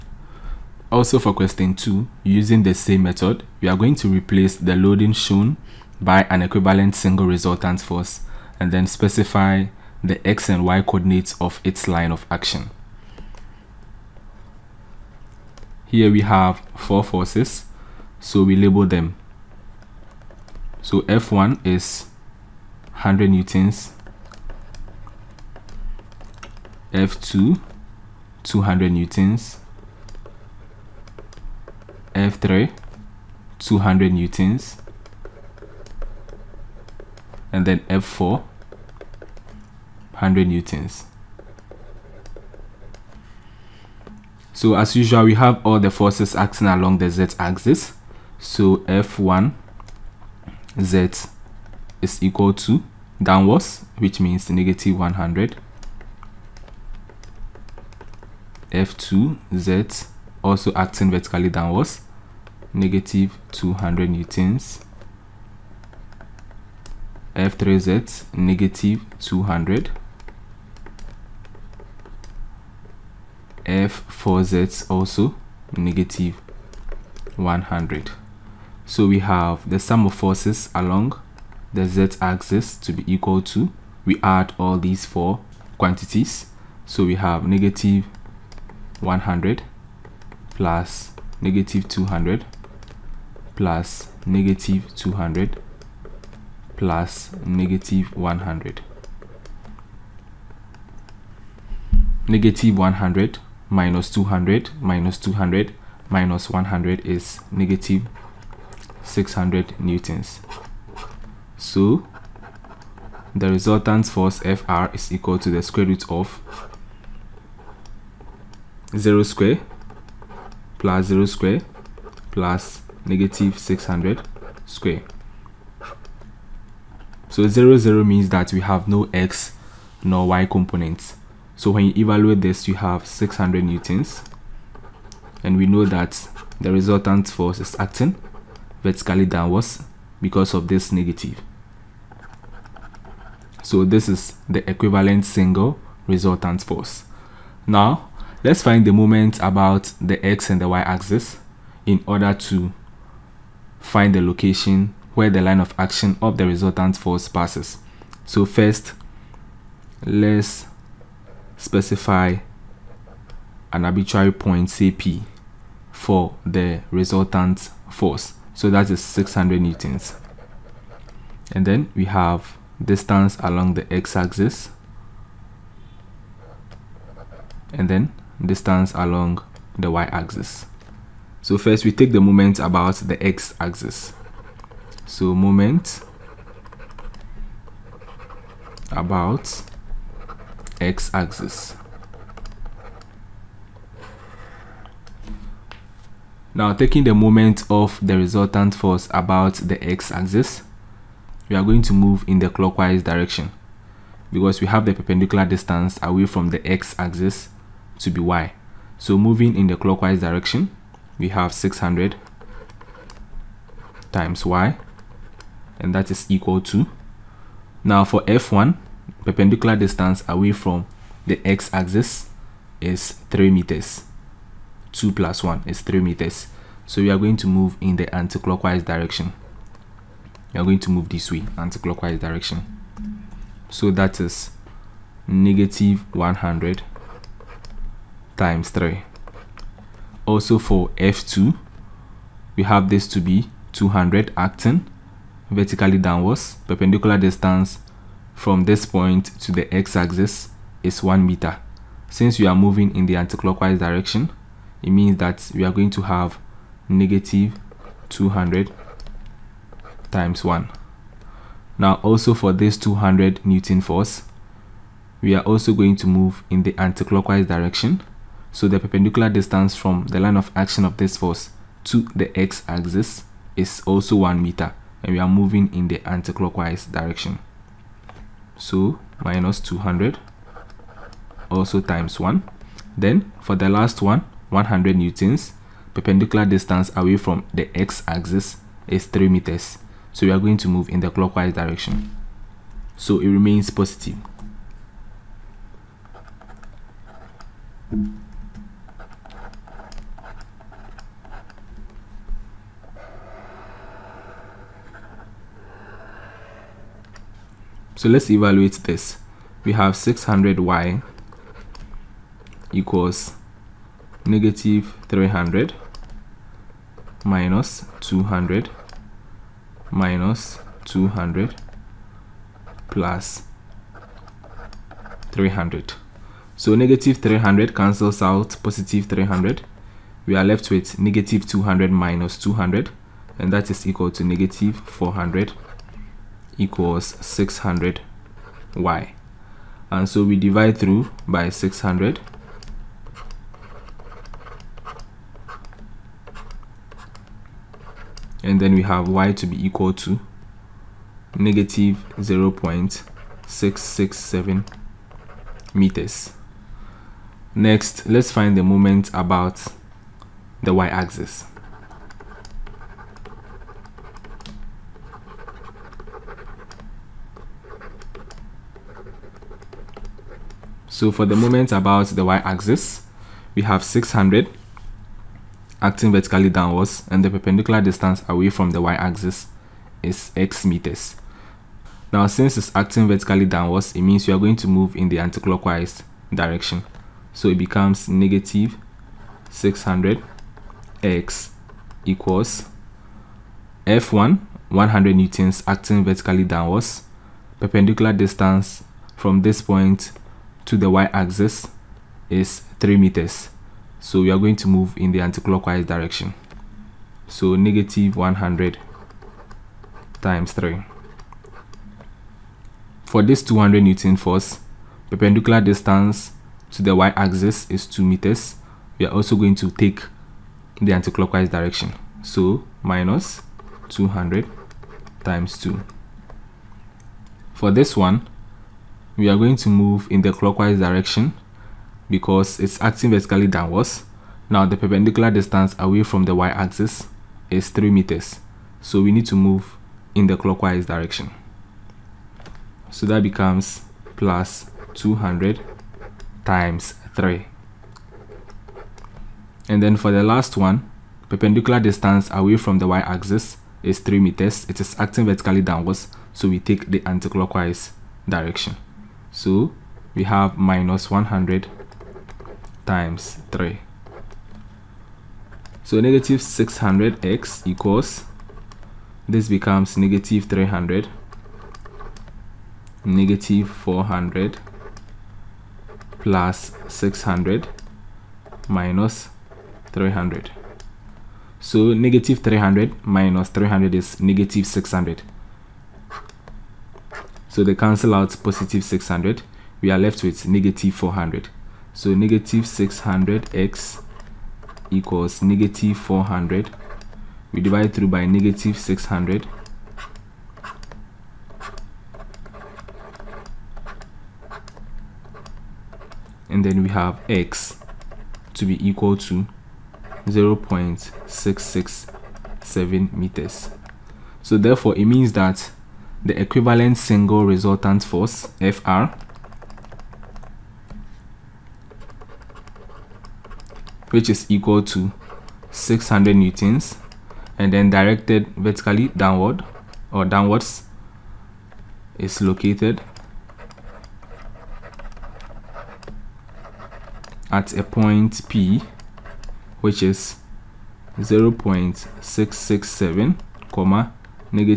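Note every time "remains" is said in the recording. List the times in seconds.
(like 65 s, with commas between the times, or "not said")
293 s.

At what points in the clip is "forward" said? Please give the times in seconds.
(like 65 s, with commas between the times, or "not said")
not said.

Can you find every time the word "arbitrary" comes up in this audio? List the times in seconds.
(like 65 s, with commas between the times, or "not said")
163 s.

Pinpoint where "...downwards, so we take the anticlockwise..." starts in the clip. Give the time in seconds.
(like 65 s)
455 s.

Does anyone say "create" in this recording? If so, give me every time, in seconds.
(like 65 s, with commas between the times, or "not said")
not said.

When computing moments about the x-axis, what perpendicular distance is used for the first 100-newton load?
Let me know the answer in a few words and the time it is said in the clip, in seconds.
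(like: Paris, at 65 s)
3 meters, at 224 s.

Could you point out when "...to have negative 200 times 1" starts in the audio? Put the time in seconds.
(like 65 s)
255 s.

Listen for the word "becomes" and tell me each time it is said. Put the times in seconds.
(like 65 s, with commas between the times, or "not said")
387 s, 443 s, 469 s.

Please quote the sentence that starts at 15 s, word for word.
Here we have four forces, so we label them.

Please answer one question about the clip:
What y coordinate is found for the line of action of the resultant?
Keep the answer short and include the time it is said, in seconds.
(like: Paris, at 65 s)
-0.667 meters, at 351 s.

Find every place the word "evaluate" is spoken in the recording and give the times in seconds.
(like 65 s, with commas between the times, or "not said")
131 s, 308 s.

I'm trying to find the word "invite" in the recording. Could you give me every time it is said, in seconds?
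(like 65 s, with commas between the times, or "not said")
not said.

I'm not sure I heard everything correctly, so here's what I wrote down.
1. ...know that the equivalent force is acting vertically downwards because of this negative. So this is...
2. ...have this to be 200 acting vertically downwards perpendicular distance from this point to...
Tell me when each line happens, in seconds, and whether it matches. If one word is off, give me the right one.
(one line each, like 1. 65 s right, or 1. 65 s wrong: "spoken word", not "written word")
1. 135 s wrong: "resultant", not "equivalent"
2. 242 s right.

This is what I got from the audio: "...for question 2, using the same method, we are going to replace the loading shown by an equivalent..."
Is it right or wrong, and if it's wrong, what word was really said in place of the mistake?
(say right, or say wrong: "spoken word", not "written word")
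right.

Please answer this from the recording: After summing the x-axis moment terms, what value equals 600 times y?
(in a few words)
-400.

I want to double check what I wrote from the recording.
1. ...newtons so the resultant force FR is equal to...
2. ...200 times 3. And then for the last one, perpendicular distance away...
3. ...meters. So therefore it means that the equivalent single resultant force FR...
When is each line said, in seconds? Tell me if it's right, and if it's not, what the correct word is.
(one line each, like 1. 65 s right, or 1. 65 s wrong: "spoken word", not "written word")
1. 109 s right
2. 444 s right
3. 513 s right.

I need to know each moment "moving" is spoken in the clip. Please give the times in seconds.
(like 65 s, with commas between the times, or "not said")
209 s, 252 s, 275 s.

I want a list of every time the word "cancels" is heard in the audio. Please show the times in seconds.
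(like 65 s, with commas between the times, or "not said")
327 s, 487 s.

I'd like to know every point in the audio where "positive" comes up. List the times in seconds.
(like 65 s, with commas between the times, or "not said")
293 s, 328 s, 488 s.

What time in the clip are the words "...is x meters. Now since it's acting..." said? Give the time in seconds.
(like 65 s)
380 s.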